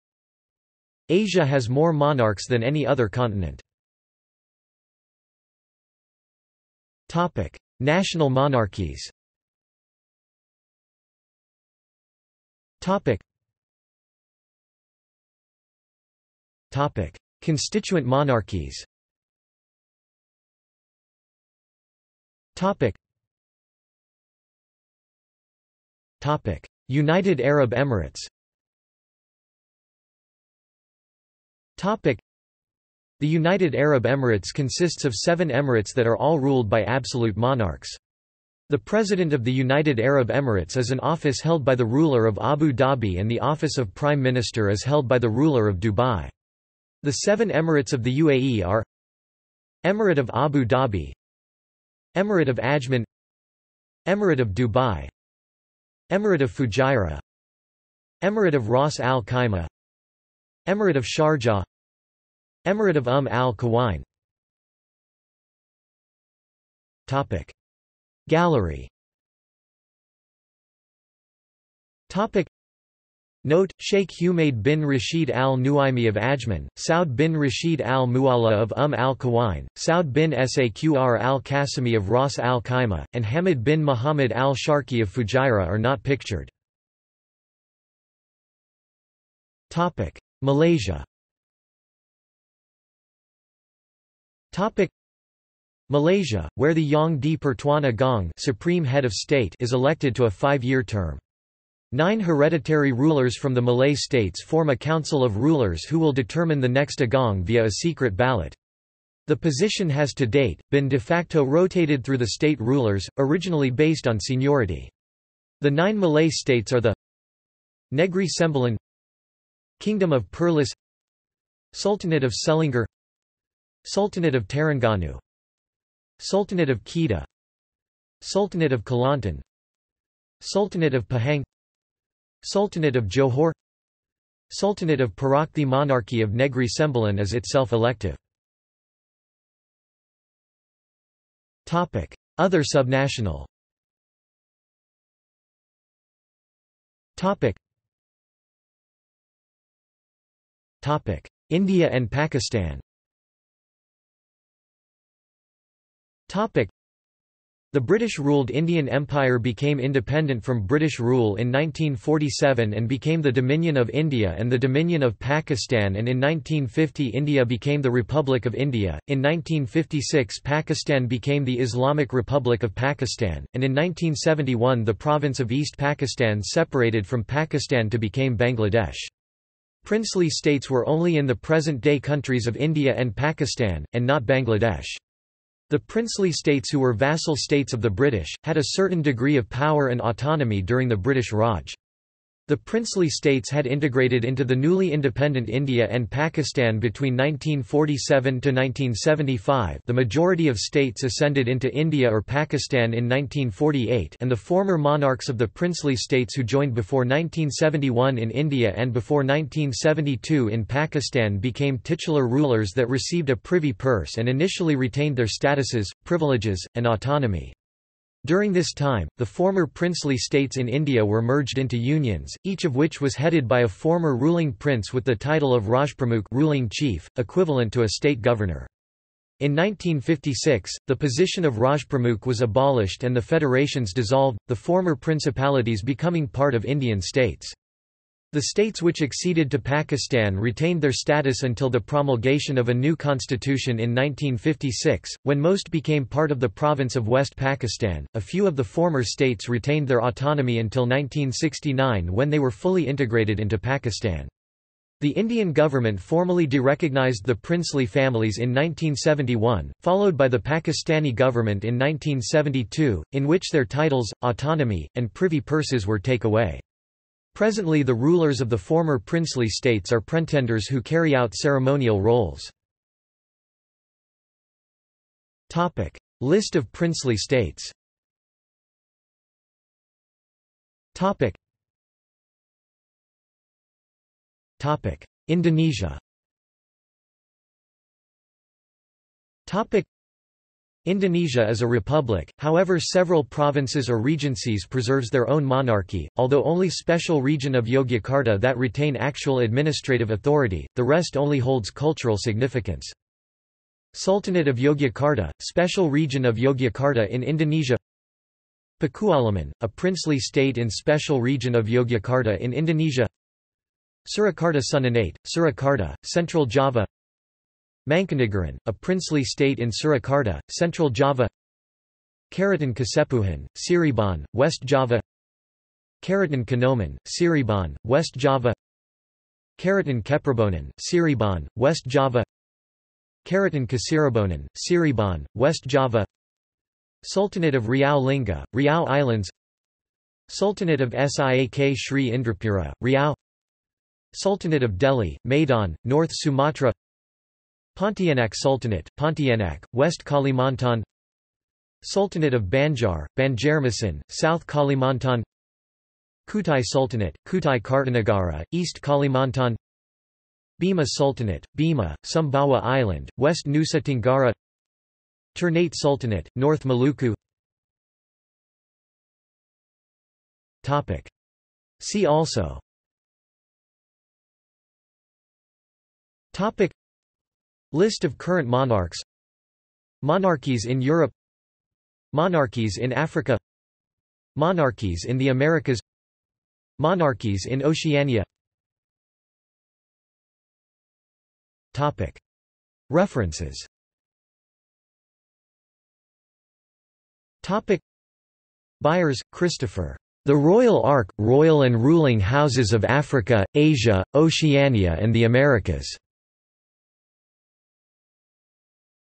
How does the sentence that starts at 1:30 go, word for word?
Malaysia Topic Malaysia, where the Yang di Pertuan Agong supreme head of state is elected to a five-year term.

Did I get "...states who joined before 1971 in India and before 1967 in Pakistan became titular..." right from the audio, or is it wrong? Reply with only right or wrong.
wrong.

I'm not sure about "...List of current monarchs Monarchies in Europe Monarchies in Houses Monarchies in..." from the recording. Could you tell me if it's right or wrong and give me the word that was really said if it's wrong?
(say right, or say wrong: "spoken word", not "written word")
wrong: "Africa", not "Houses".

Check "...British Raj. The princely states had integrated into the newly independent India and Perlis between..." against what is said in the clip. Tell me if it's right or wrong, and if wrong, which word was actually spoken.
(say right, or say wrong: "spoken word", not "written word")
wrong: "Pakistan", not "Perlis".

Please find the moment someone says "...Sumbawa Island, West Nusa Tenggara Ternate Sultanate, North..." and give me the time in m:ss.
6:02.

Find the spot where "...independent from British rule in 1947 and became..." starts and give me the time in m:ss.
2:39.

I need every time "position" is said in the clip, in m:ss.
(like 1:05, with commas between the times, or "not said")
1:49, 3:50.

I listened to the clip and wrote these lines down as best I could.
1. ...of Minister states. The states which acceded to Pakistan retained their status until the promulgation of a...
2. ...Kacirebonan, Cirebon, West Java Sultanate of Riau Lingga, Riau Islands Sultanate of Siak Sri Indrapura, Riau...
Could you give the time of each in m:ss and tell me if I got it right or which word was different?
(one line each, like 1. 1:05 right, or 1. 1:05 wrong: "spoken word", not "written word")
1. 3:56 wrong: "Indian", not "Minister"
2. 5:33 right.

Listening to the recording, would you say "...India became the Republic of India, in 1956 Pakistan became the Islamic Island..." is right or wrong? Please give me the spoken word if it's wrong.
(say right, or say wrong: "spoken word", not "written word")
wrong: "Republic", not "Island".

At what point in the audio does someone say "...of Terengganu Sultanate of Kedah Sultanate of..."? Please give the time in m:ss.
2:04.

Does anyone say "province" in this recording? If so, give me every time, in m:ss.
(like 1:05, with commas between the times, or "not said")
2:54, 4:06, 4:53.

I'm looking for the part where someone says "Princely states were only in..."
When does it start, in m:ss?
2:59.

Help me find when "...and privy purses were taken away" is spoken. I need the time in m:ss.
4:24.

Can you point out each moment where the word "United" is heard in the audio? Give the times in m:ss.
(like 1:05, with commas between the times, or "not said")
0:26, 0:33, 0:39.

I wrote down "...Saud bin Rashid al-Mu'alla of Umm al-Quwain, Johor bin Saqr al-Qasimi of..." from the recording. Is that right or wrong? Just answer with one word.
wrong.